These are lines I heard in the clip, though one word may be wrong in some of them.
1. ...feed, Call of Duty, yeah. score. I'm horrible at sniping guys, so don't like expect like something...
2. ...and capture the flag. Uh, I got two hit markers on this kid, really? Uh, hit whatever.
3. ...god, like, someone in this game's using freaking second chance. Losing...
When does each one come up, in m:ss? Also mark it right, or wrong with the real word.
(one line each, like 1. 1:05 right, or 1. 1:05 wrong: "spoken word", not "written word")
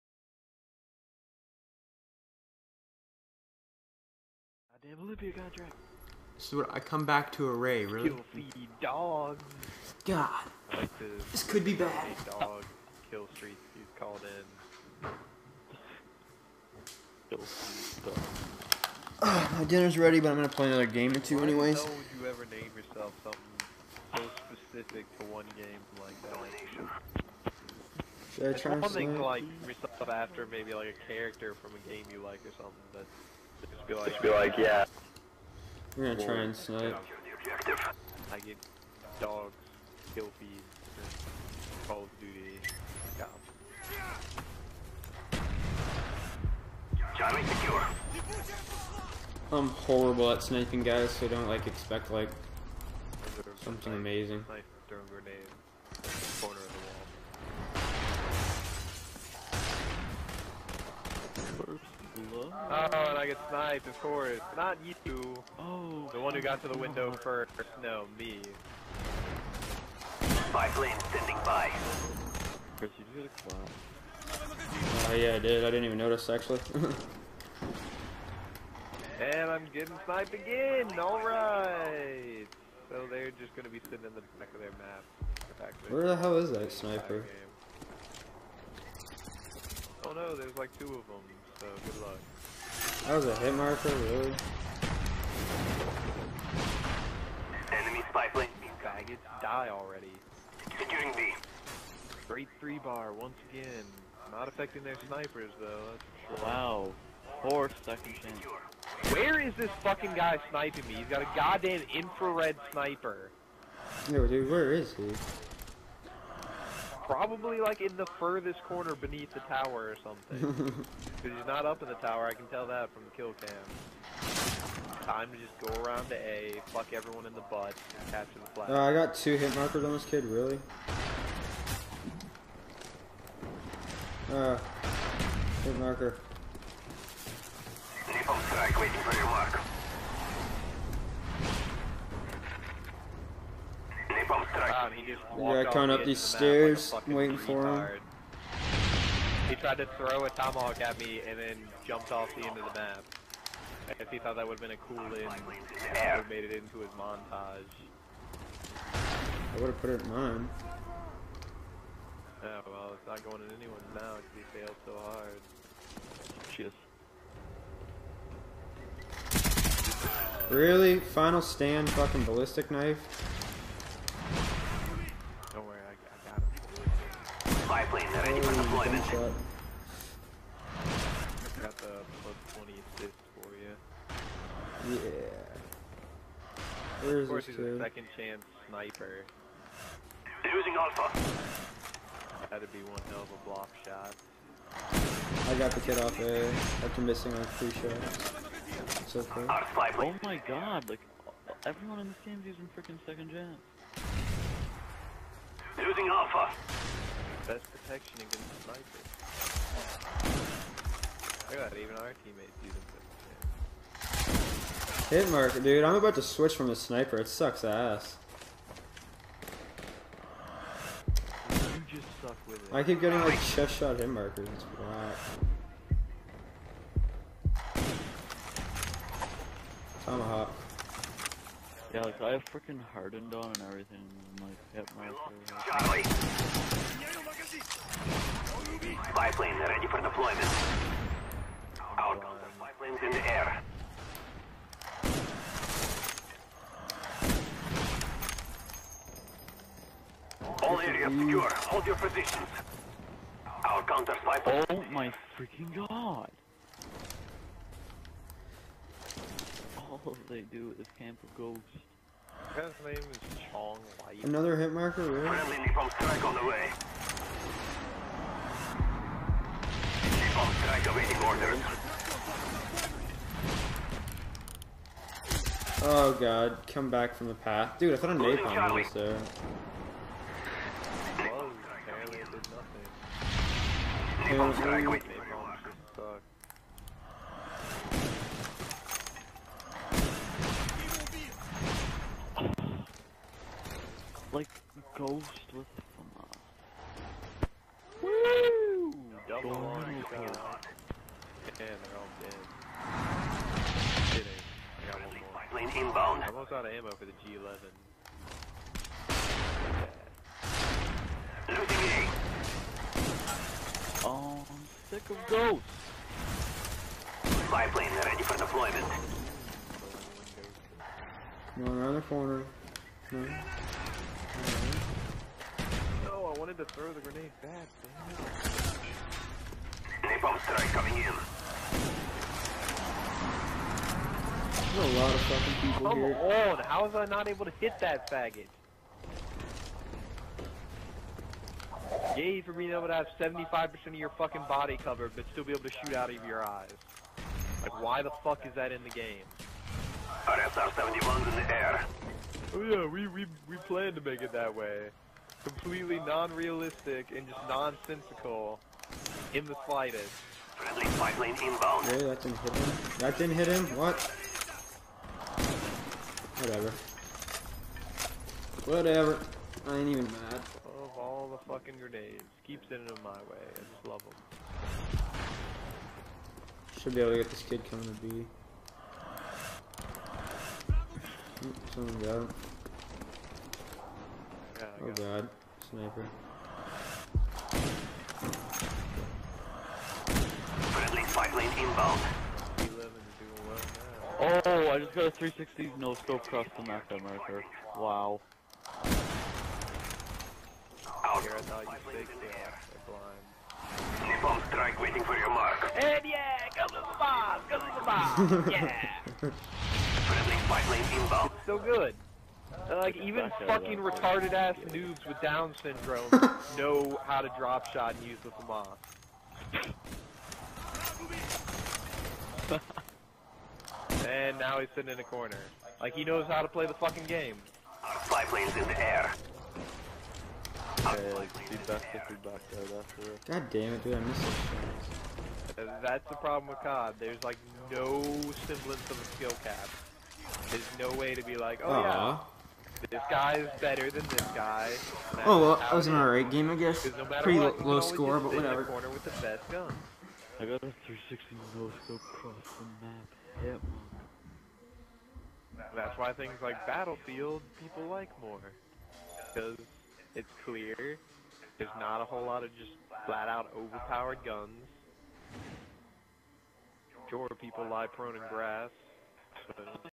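1. 0:40 wrong: "secure", not "score"
2. 2:07 wrong: "marker", not "whatever"
3. 3:20 wrong: "everyone", not "someone".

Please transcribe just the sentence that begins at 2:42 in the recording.
Yeah, oh, well, it's not going in anyone's now because he failed so hard.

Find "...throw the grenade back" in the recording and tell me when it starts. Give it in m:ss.
5:26.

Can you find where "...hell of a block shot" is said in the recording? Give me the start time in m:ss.
3:13.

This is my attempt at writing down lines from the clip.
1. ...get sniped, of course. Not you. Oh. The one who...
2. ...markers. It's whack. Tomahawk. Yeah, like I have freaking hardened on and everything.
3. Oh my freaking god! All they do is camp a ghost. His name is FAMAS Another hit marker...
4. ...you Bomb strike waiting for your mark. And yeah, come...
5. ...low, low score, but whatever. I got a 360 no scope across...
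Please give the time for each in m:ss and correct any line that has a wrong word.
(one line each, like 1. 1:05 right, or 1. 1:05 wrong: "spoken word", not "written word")
1. 1:03 right
2. 3:44 right
3. 4:14 wrong: "Chong", not "FAMAS"
4. 6:44 right
5. 7:27 right.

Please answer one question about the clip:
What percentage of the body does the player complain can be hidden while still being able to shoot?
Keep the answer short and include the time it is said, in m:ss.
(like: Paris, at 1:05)
75%, at 5:43.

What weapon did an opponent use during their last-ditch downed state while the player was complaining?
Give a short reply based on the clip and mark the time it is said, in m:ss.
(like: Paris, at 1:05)
ballistic knife, at 2:52.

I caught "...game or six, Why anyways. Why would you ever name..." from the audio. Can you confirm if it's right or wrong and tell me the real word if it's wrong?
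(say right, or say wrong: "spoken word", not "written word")
wrong: "two", not "six".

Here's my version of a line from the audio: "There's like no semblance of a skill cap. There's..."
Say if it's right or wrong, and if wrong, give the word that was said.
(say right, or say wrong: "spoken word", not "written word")
right.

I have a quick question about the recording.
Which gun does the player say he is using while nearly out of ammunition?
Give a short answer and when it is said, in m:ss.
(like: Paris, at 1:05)
G11, at 5:07.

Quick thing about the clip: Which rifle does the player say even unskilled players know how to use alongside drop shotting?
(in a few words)
FAMAS.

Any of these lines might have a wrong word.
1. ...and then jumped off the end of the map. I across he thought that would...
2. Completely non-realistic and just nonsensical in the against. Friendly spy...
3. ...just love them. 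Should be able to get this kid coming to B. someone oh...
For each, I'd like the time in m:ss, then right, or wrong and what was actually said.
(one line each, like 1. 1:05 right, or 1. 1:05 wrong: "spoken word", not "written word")
1. 2:31 wrong: "guess", not "across"
2. 5:55 wrong: "slightest", not "against"
3. 6:13 right.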